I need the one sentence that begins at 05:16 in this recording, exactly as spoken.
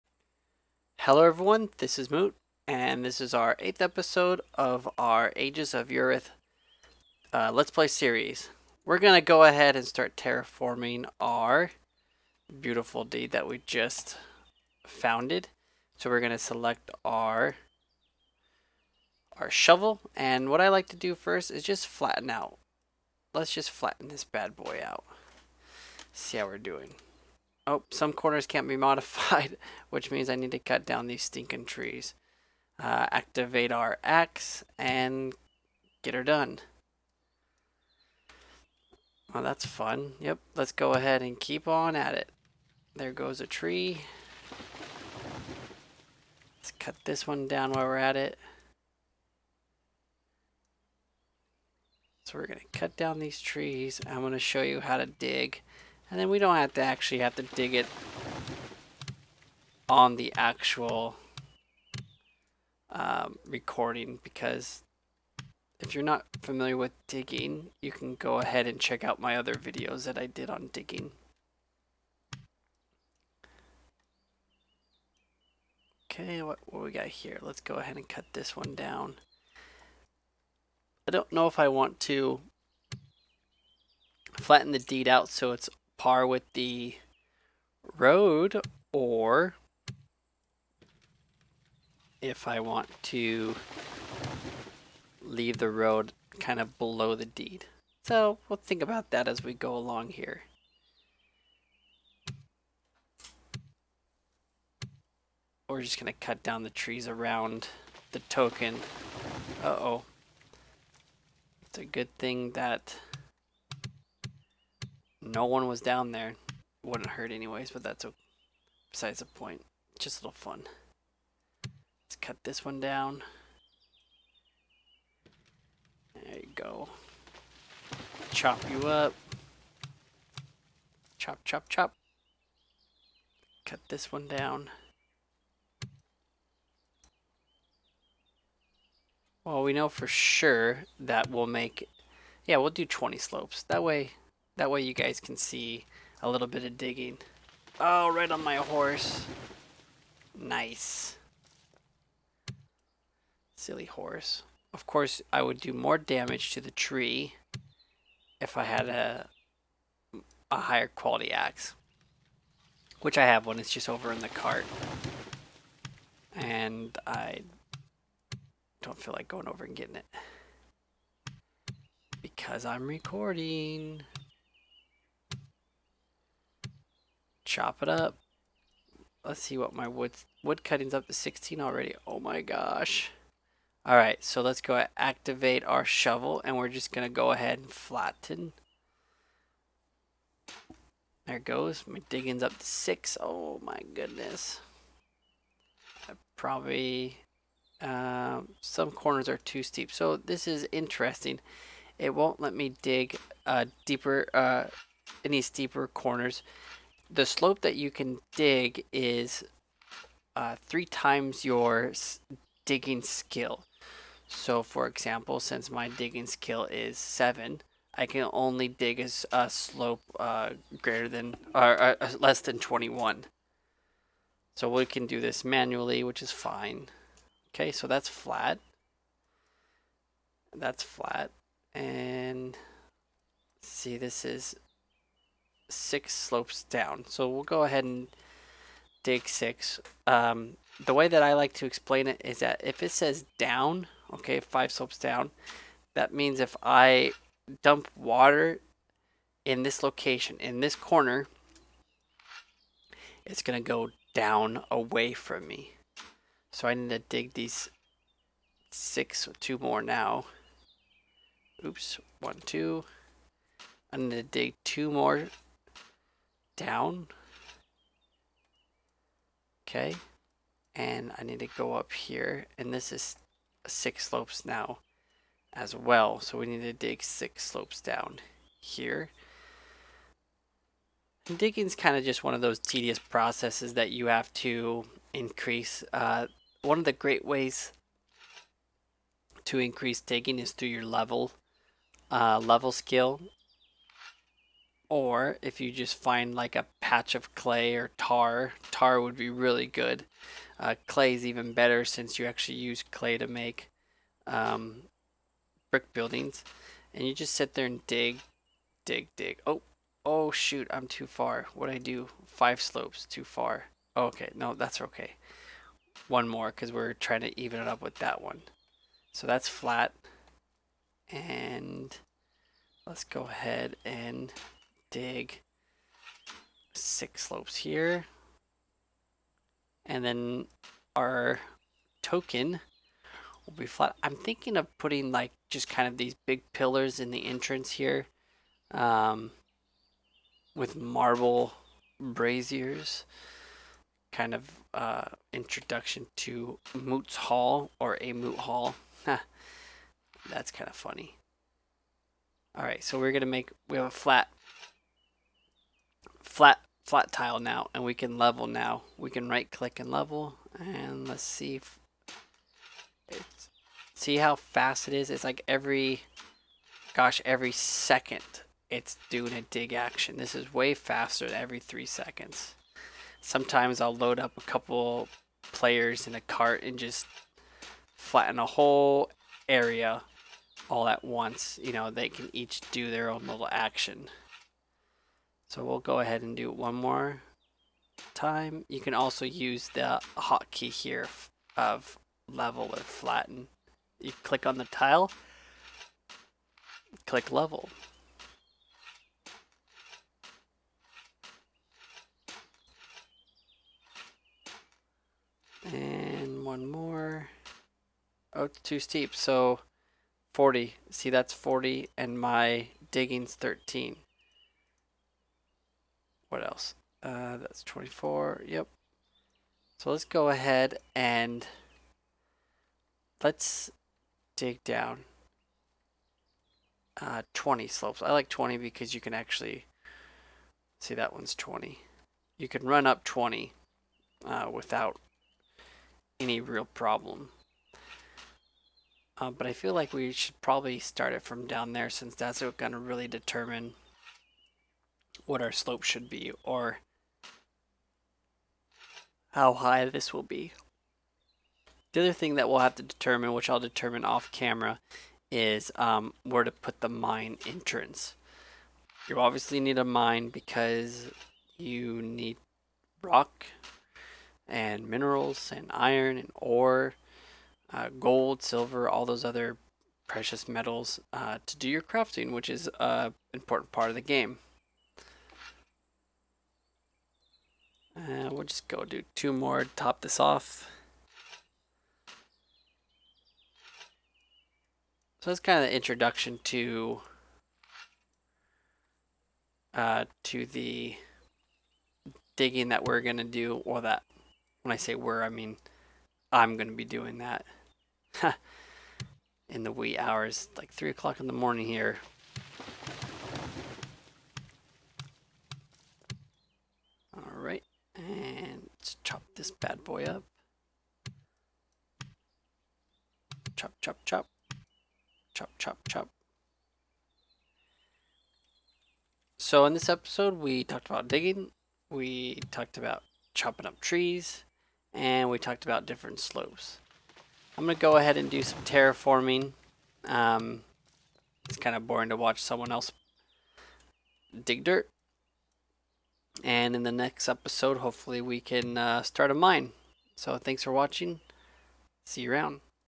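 One more because we're trying to even it up with that one.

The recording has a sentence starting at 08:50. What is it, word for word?
Um, it's kind of boring to watch someone else dig dirt.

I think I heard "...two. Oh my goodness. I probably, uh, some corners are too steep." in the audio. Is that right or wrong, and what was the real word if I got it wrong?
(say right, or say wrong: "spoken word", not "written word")
wrong: "six", not "two".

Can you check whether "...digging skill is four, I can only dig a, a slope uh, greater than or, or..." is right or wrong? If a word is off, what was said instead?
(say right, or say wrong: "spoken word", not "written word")
wrong: "seven", not "four".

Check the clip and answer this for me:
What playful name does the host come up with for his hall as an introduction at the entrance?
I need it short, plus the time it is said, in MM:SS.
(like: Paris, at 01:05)
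Moot Hall, at 05:48.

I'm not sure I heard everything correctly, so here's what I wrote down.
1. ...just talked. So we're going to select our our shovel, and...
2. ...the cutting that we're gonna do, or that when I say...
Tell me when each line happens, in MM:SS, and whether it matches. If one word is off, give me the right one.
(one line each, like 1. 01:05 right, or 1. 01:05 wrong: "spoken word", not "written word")
1. 00:13 wrong: "founded", not "talked"
2. 08:10 wrong: "digging", not "cutting".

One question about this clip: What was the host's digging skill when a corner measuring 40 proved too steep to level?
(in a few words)
13.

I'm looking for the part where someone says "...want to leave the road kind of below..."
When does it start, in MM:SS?
01:32.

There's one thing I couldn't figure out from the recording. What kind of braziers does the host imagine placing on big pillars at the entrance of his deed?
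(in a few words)
Marble.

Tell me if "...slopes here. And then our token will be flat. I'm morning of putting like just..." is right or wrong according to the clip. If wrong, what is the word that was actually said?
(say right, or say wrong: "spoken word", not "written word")
wrong: "thinking", not "morning".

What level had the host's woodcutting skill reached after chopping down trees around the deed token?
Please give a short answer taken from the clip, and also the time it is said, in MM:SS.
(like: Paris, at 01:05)
16, at 03:01.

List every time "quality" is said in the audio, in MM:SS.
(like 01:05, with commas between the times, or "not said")
02:40.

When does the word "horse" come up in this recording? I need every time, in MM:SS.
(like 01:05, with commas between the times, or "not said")
02:28, 02:33.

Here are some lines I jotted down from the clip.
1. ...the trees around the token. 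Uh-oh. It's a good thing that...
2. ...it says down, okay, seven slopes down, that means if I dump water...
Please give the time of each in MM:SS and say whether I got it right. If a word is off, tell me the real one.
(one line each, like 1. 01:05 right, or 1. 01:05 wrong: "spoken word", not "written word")
1. 01:46 right
2. 04:02 wrong: "five", not "seven".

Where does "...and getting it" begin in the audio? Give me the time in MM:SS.
02:49.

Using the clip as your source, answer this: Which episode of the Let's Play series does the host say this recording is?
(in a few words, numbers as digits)
8th.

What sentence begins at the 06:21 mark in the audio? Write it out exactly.
You know, they can each do their own little action.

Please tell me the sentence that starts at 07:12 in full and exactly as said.
You can run up 20 uh, without any real problem.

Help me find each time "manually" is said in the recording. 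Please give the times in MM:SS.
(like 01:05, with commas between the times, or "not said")
03:45.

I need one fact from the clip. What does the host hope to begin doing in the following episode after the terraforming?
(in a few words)
Start a mine.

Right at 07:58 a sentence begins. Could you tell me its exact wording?
we'll just go do two more, to top this off.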